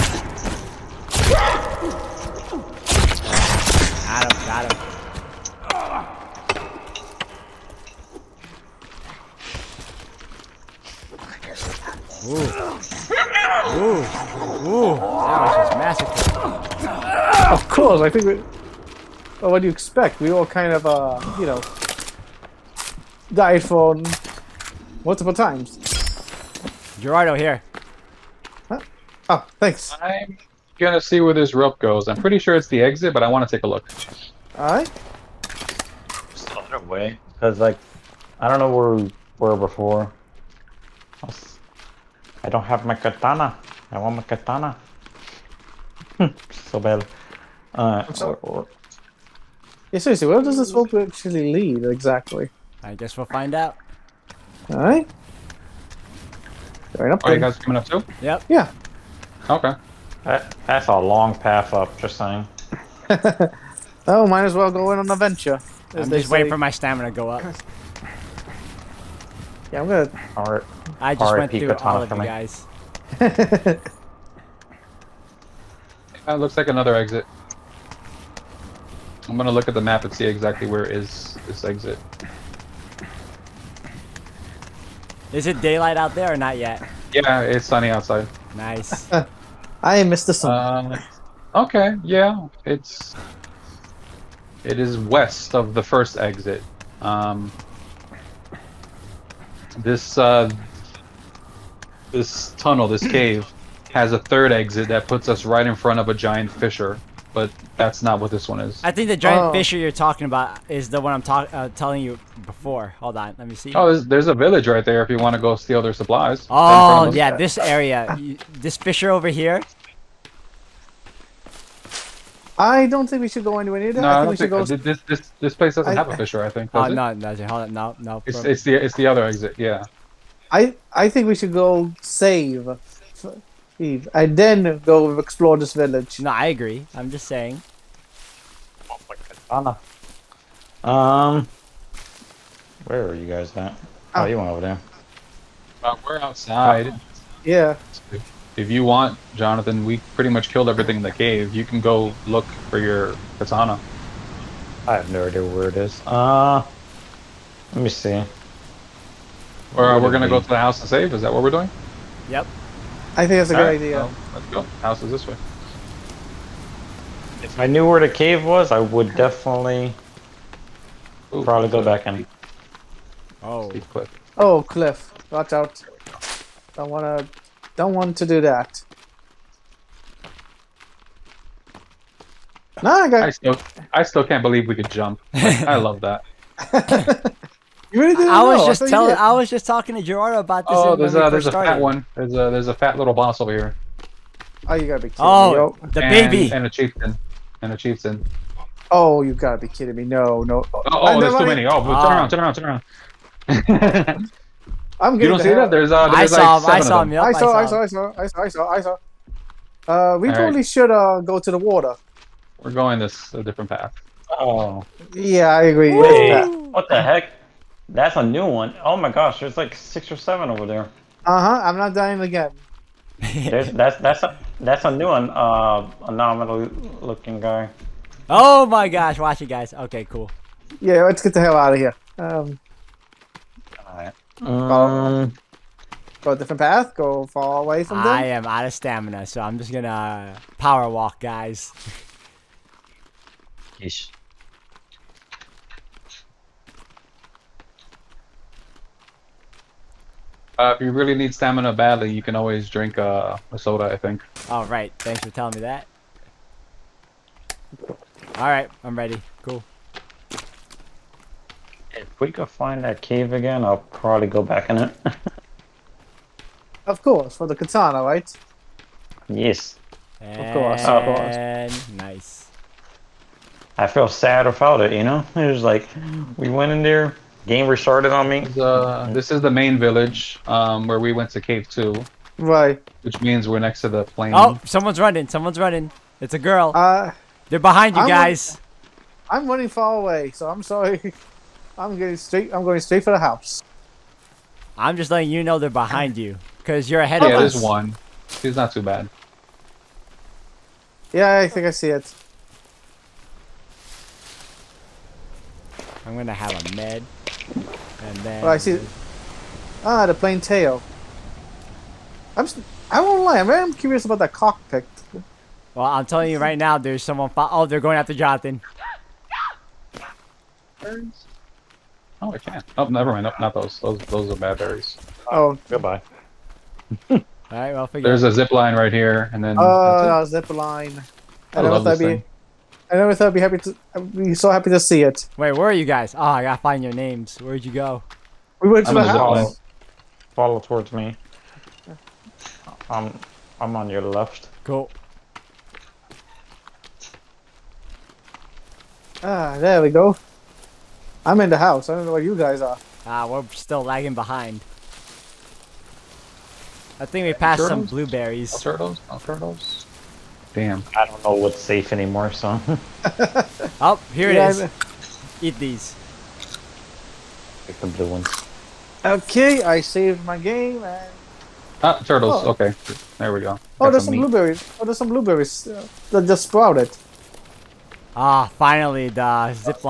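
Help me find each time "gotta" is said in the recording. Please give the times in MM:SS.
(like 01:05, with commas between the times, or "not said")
03:14, 03:19, 05:36.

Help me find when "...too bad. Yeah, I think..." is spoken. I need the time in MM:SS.
04:58.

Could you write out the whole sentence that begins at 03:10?
Oh, there's a there's a started.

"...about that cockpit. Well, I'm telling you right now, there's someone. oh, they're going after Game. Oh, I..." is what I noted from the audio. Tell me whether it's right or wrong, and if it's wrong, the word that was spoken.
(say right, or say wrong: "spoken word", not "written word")
wrong: "Jonathan", not "Game".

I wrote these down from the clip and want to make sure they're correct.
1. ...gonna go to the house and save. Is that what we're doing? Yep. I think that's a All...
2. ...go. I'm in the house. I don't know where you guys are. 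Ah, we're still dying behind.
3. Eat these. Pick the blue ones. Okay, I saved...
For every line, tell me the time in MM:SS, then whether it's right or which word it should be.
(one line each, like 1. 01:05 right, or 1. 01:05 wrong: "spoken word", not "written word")
1. 02:40 right
2. 05:49 wrong: "lagging", not "dying"
3. 06:05 right.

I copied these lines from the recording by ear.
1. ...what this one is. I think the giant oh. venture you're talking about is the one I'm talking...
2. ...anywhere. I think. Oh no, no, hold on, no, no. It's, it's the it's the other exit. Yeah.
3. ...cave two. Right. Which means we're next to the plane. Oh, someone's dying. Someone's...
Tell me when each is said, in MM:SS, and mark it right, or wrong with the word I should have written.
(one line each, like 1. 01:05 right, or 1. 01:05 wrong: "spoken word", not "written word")
1. 01:48 wrong: "fissure", not "venture"
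2. 02:06 wrong: "fissure", not "anywhere"
3. 04:41 wrong: "running", not "dying".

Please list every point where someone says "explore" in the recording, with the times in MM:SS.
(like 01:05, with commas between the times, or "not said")
02:15.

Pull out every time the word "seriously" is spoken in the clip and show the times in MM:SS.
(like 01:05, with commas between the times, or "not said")
00:49.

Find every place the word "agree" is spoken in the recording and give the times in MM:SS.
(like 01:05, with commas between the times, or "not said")
02:16, 03:35.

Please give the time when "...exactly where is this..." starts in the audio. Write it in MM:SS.
01:20.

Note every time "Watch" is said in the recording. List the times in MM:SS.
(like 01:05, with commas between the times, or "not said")
02:55, 03:49.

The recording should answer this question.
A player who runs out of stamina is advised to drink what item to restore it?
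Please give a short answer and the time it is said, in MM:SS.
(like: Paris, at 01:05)
soda, at 04:13.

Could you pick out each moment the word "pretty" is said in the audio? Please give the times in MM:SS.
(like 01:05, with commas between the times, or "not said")
00:32, 02:30.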